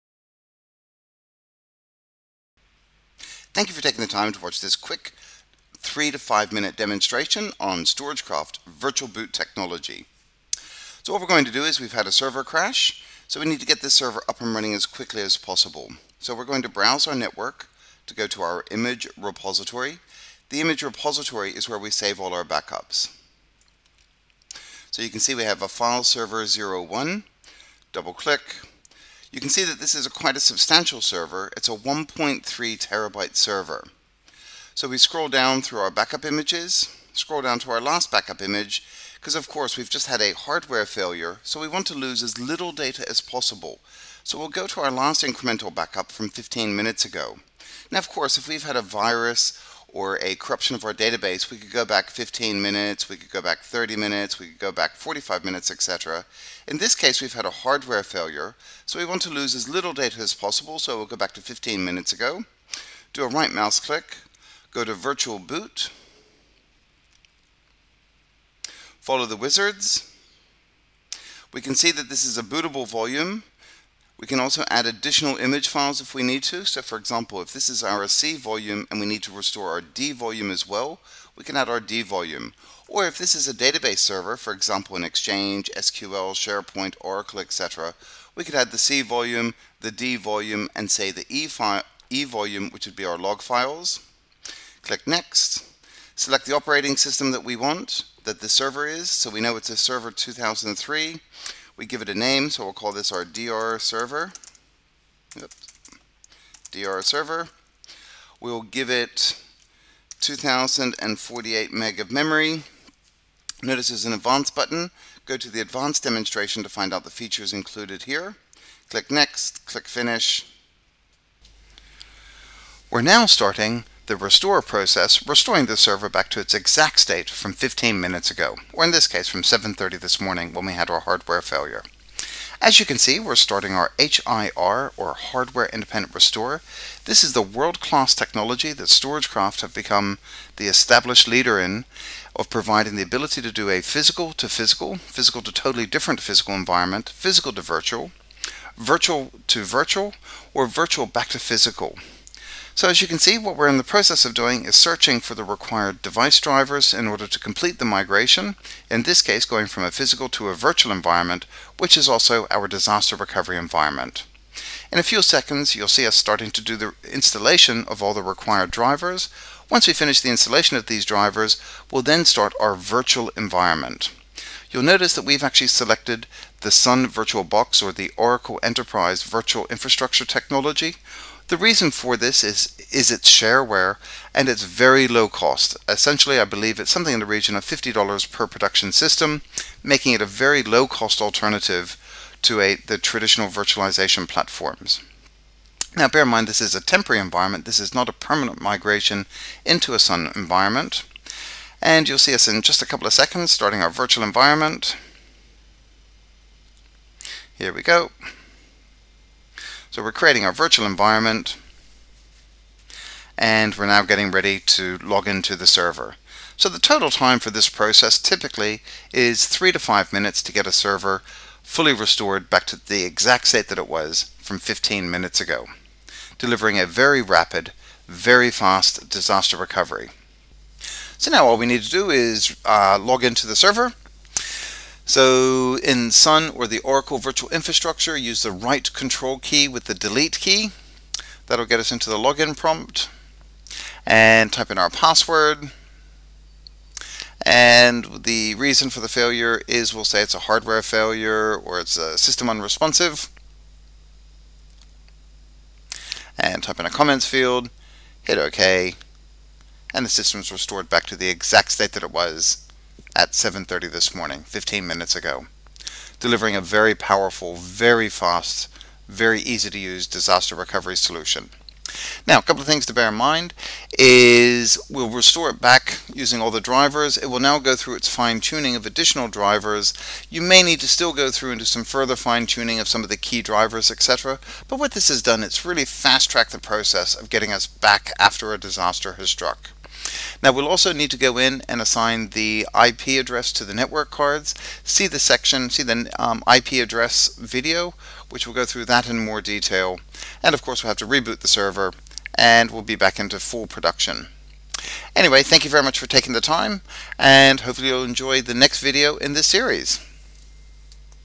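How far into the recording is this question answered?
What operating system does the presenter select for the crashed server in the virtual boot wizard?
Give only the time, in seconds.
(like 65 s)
99 s.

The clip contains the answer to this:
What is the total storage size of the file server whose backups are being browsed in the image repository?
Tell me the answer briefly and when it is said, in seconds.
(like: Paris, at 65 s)
1.3 terabytes, at 31 s.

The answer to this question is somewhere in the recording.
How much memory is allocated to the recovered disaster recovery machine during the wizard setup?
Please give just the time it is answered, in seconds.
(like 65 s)
110 s.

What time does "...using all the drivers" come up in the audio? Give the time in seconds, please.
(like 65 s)
276 s.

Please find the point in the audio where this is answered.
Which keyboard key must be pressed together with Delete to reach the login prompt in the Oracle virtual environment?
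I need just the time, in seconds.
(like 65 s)
238 s.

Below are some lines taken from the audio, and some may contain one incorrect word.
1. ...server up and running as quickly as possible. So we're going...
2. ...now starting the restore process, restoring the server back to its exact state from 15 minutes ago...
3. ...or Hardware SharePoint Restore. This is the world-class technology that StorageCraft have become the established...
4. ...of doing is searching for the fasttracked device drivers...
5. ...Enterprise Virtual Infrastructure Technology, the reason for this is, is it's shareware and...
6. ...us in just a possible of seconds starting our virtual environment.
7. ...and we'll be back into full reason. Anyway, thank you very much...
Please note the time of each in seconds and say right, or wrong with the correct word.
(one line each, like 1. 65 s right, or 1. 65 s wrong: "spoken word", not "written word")
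1. 13 s right
2. 123 s right
3. 134 s wrong: "Independent", not "SharePoint"
4. 154 s wrong: "required", not "fasttracked"
5. 178 s right
6. 202 s wrong: "couple", not "possible"
7. 302 s wrong: "production", not "reason".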